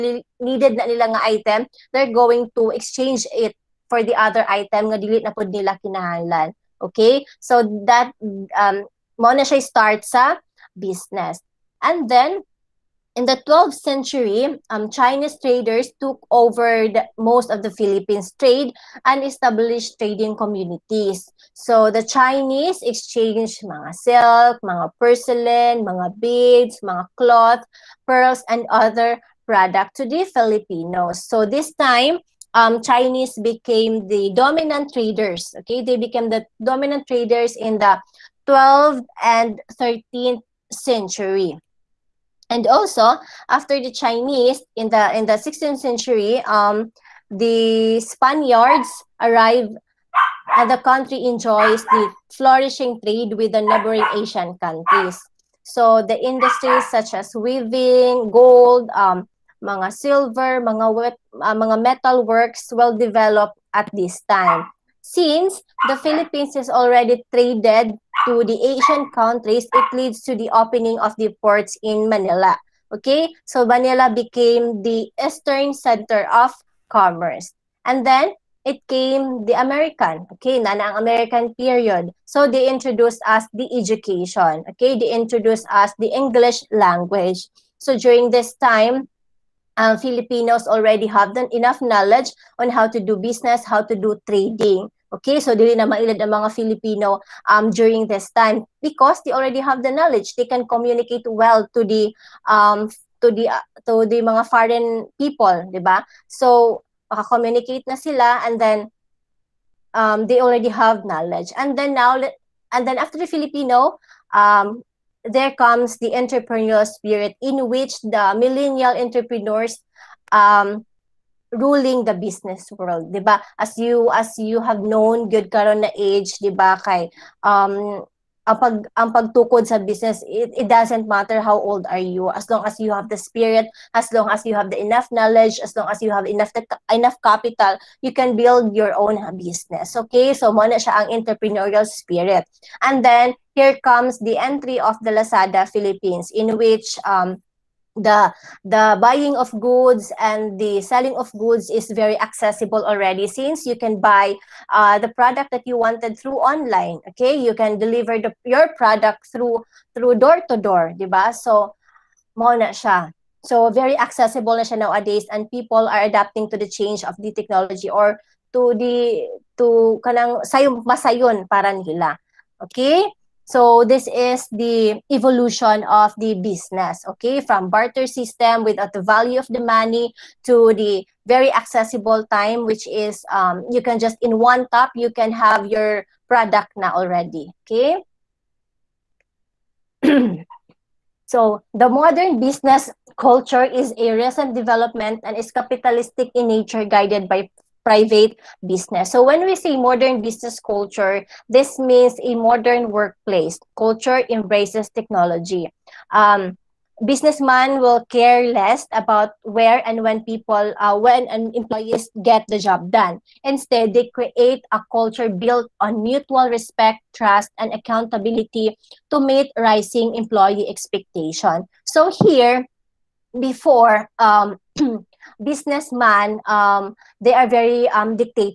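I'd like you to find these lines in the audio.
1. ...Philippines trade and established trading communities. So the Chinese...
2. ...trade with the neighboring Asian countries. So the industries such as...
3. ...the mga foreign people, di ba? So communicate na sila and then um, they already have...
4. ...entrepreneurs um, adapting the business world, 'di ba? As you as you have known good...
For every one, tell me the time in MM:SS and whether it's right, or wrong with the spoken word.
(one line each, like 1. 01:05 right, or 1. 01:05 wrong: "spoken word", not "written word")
1. 00:17 right
2. 00:53 right
3. 01:44 right
4. 01:58 wrong: "ruling", not "adapting".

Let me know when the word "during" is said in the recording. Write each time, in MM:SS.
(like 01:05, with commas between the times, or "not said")
01:27, 01:37.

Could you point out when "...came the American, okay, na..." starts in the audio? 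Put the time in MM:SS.
01:18.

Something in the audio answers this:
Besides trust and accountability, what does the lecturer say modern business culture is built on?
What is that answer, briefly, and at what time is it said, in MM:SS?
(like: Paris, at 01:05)
Mutual respect, at 03:35.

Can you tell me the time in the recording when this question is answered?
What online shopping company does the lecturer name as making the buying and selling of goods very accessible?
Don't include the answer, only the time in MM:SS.
02:25.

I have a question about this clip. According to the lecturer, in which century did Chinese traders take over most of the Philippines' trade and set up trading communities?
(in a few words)
12th century.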